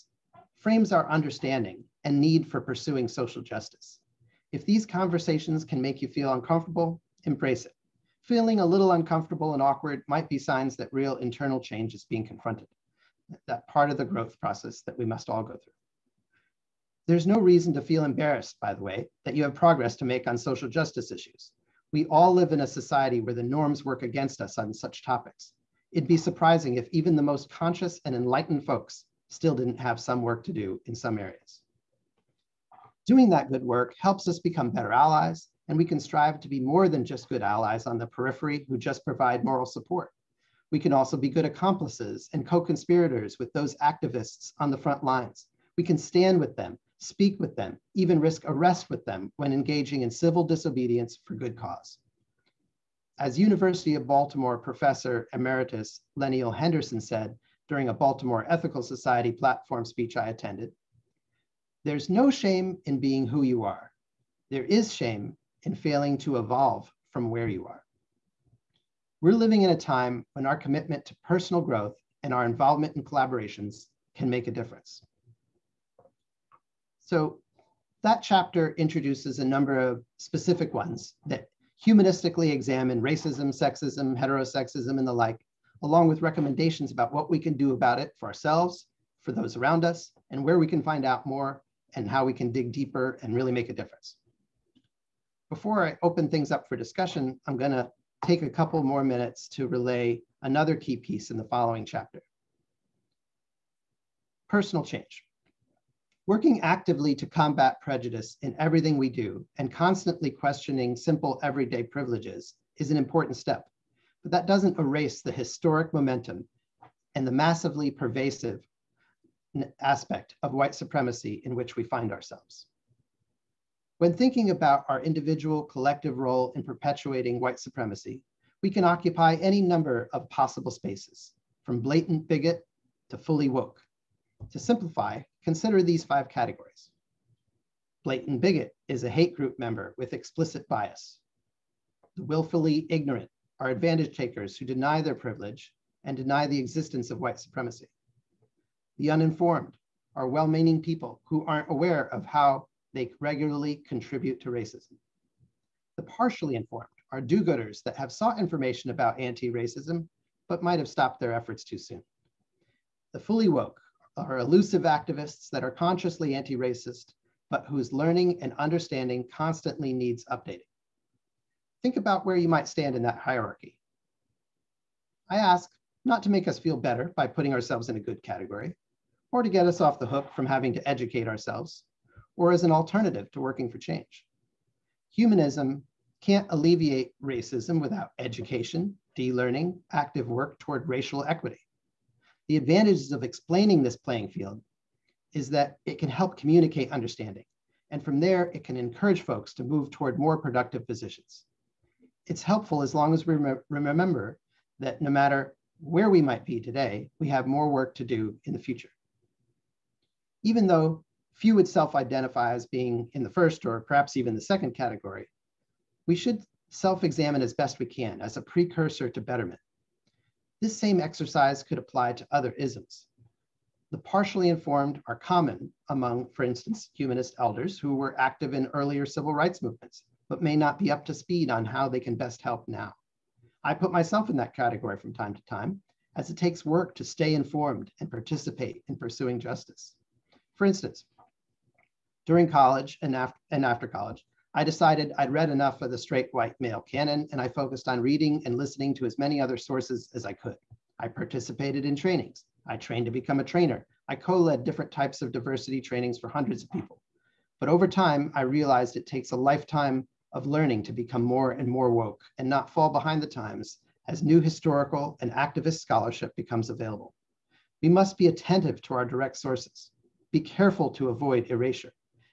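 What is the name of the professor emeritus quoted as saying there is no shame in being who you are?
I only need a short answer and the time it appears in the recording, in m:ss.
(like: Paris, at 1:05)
Lenneal Henderson, at 0:56.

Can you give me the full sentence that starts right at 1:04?
There is shame and failing to evolve from where you are.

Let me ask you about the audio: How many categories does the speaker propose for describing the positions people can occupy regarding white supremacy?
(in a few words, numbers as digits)
5.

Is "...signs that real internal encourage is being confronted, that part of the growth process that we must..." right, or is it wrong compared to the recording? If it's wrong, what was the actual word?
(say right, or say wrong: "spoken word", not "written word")
wrong: "change", not "encourage".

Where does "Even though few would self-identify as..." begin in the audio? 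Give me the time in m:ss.
3:30.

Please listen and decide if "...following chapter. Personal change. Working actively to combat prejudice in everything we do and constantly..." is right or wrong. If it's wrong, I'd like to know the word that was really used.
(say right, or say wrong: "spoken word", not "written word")
right.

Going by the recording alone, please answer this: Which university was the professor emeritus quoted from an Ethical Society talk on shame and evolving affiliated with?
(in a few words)
University of Baltimore.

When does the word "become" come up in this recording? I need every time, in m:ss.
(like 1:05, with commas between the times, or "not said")
0:34, 4:13, 4:20, 4:26.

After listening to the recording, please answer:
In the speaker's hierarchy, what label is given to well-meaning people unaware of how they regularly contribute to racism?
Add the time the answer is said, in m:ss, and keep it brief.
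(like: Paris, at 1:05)
The uninformed, at 2:28.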